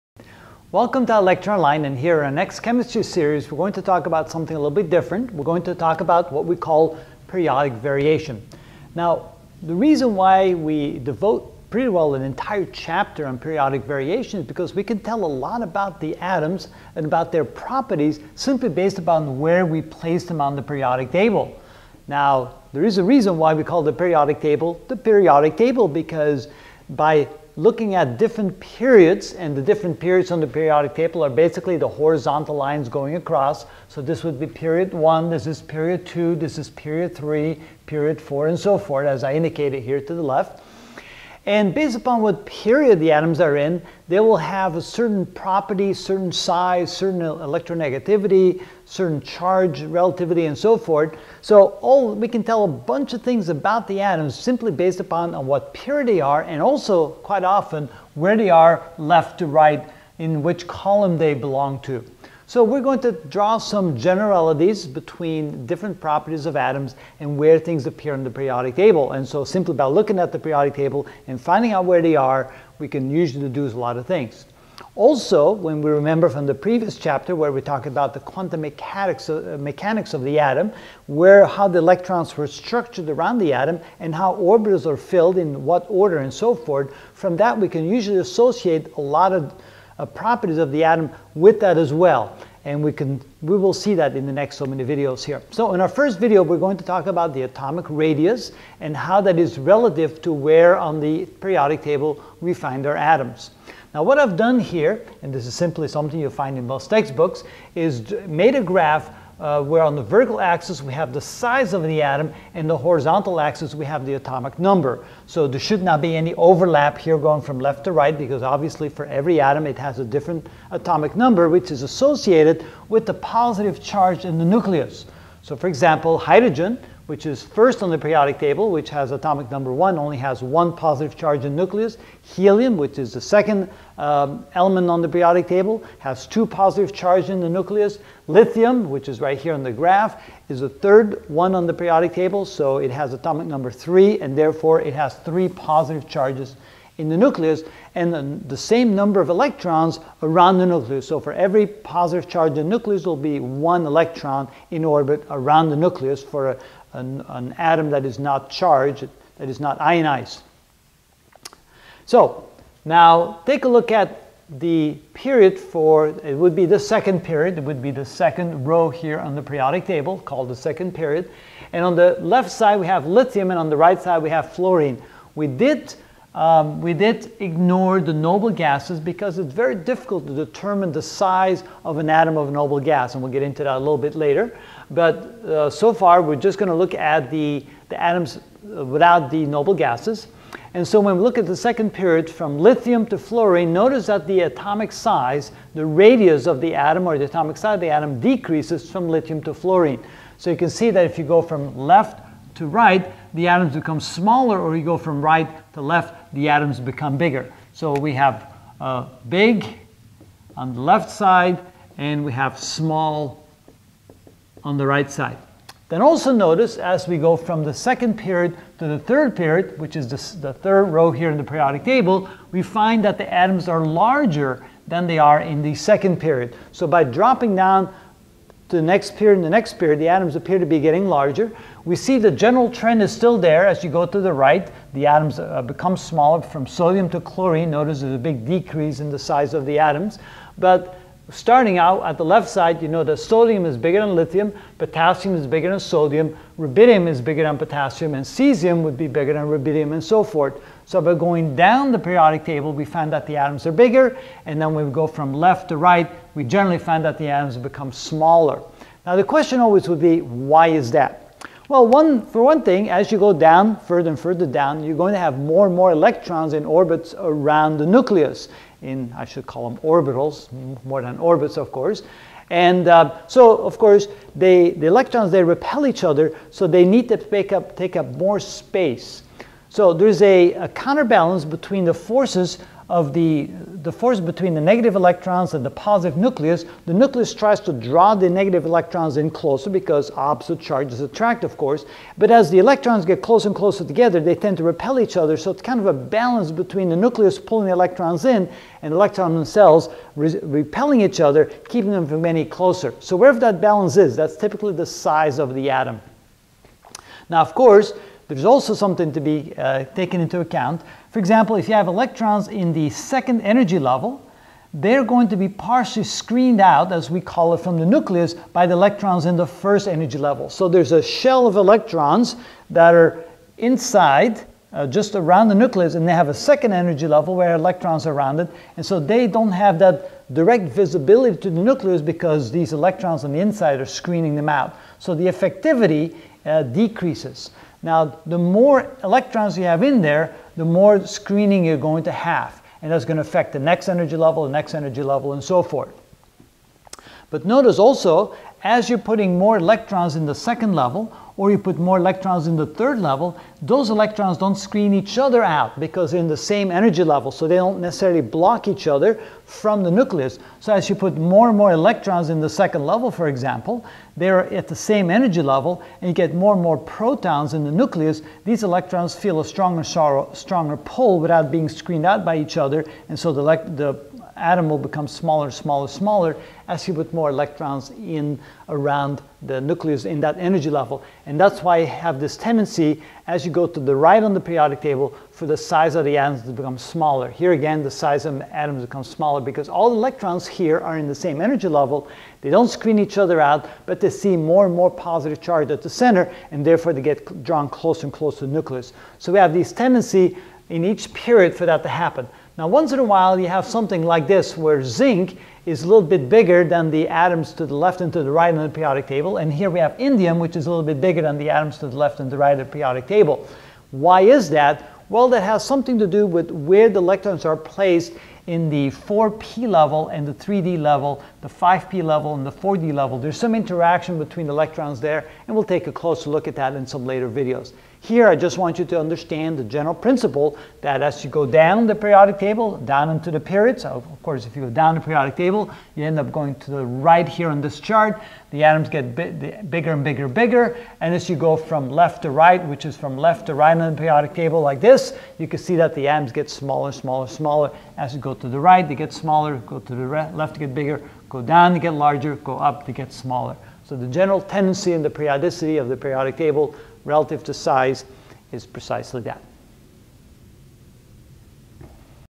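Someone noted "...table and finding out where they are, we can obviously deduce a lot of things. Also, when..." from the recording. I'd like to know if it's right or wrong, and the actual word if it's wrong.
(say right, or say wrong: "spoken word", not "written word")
wrong: "usually", not "obviously".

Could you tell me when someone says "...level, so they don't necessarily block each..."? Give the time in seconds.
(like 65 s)
357 s.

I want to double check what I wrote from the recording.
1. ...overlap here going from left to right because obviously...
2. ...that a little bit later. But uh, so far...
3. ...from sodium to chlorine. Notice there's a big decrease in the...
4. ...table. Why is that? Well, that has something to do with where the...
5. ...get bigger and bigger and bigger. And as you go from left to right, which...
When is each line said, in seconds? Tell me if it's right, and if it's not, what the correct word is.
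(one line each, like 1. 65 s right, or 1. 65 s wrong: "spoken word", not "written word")
1. 116 s right
2. 183 s right
3. 236 s right
4. 413 s right
5. 438 s right.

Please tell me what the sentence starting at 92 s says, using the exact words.
And we, can, we will see that in the next so many videos here.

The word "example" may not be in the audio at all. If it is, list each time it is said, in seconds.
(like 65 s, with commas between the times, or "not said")
125 s, 311 s, 363 s.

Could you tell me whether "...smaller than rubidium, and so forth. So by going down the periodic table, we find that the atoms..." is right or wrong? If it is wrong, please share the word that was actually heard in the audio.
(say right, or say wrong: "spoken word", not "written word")
wrong: "bigger", not "smaller".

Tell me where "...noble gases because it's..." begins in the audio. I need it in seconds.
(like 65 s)
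178 s.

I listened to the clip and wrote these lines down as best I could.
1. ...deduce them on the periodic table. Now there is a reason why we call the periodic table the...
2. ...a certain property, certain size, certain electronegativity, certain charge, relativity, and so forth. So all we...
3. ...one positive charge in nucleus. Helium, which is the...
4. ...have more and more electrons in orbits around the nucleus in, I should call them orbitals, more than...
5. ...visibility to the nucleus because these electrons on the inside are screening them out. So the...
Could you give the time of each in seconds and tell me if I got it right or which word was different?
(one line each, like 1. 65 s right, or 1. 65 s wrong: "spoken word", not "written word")
1. 19 s wrong: "place", not "deduce"
2. 44 s right
3. 130 s right
4. 265 s right
5. 330 s right.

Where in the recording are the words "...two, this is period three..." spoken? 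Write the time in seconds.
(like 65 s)
36 s.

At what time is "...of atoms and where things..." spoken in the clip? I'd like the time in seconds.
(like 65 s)
66 s.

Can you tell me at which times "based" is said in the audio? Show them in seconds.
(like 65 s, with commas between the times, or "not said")
18 s, 41 s, 54 s.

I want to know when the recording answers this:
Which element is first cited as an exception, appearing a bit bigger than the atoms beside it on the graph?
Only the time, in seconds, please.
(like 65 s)
404 s.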